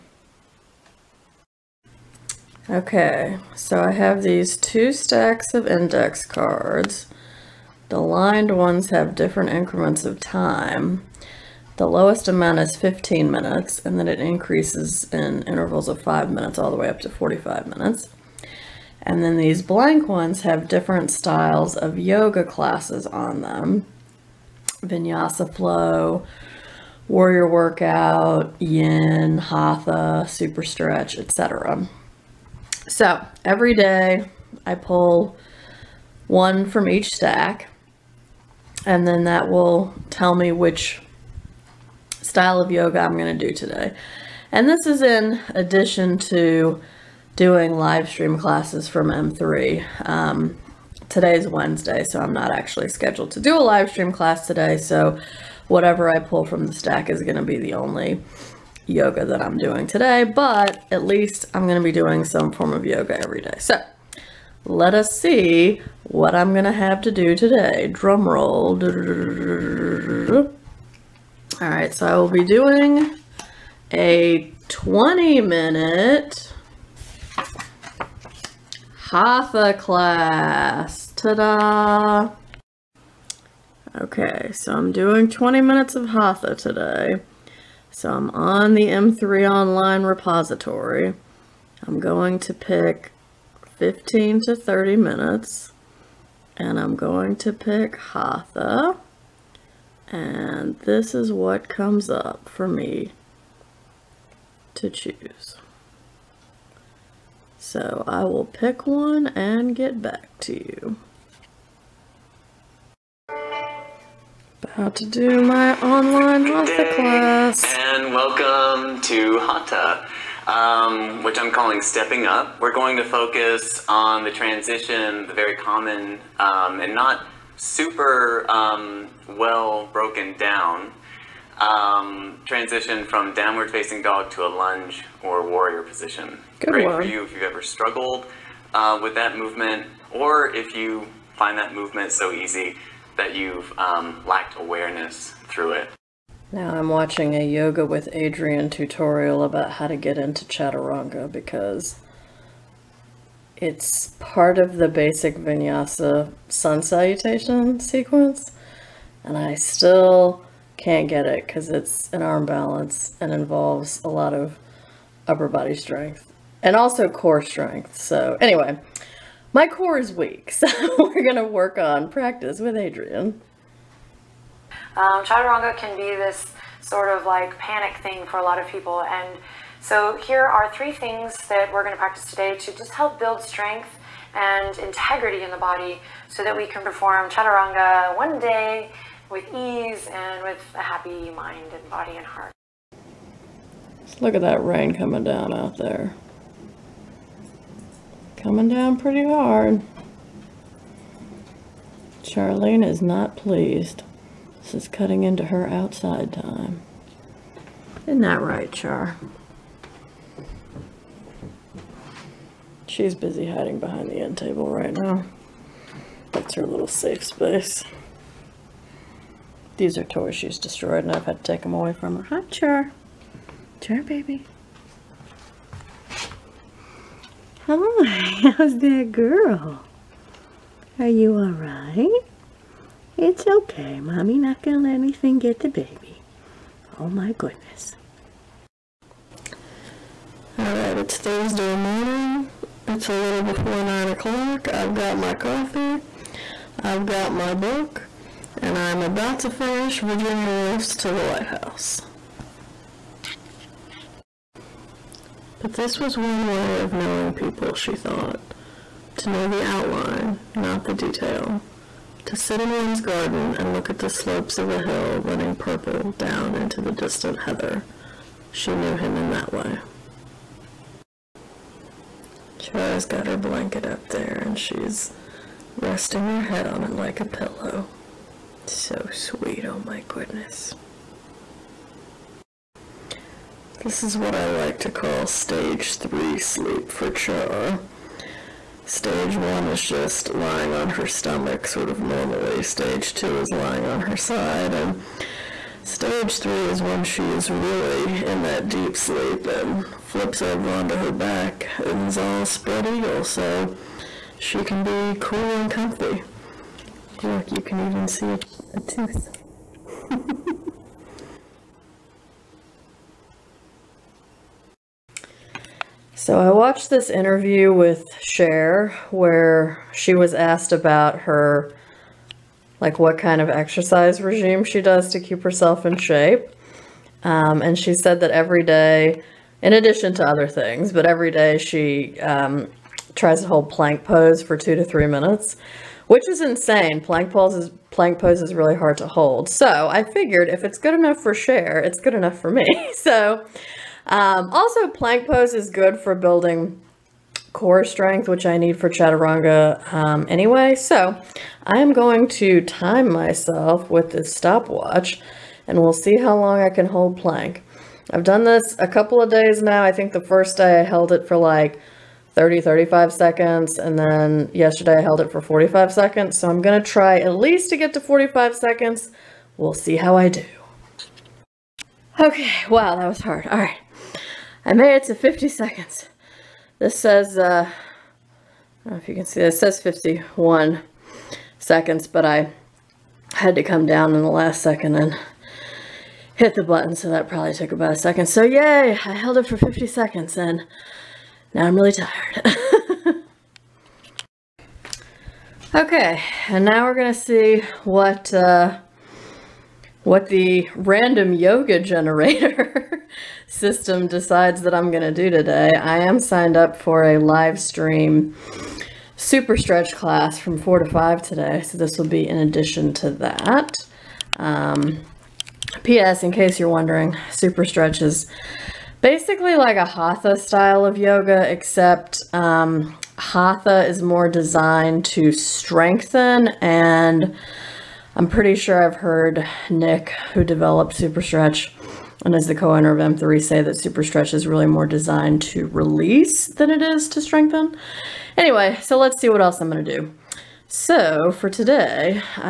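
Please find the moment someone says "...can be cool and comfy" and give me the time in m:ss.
5:04.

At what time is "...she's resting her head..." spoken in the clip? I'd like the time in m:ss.
4:34.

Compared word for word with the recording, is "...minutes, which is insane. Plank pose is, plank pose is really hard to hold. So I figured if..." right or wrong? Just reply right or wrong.
right.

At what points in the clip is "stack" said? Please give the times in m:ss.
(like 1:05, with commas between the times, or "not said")
0:04, 0:37, 0:56.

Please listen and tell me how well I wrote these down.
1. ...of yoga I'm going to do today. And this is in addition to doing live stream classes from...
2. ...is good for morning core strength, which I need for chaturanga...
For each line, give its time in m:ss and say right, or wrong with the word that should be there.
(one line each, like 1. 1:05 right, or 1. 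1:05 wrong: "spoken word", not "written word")
1. 0:42 right
2. 5:45 wrong: "building", not "morning".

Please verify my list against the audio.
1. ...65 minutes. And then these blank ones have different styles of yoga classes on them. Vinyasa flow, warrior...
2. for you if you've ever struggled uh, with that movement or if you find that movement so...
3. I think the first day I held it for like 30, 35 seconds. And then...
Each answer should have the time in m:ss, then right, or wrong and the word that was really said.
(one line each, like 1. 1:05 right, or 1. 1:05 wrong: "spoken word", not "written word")
1. 0:17 wrong: "45", not "65"
2. 2:17 right
3. 5:59 right.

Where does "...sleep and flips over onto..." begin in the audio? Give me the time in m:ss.
4:58.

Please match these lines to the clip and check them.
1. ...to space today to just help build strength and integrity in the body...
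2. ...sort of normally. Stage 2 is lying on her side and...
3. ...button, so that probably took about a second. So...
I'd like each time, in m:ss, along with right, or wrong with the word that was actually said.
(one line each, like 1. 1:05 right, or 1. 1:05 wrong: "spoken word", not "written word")
1. 3:01 wrong: "practice", not "space"
2. 4:51 right
3. 6:26 right.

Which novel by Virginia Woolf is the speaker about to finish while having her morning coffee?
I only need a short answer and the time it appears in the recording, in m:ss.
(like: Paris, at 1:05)
To the Lighthouse, at 4:10.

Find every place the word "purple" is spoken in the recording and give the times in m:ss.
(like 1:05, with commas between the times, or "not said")
4:25.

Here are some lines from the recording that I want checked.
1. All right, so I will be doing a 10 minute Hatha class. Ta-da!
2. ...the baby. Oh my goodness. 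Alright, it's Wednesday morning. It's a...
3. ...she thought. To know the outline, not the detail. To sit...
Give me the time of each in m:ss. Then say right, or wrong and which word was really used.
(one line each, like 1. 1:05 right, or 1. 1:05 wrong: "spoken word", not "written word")
1. 1:11 wrong: "20", not "10"
2. 3:55 wrong: "Thursday", not "Wednesday"
3. 4:17 right.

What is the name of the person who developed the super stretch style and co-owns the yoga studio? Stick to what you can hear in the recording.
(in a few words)
Nick.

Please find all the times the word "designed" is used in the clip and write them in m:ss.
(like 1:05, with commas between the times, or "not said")
7:04, 7:14.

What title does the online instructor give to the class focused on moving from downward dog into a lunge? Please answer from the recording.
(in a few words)
Stepping Up.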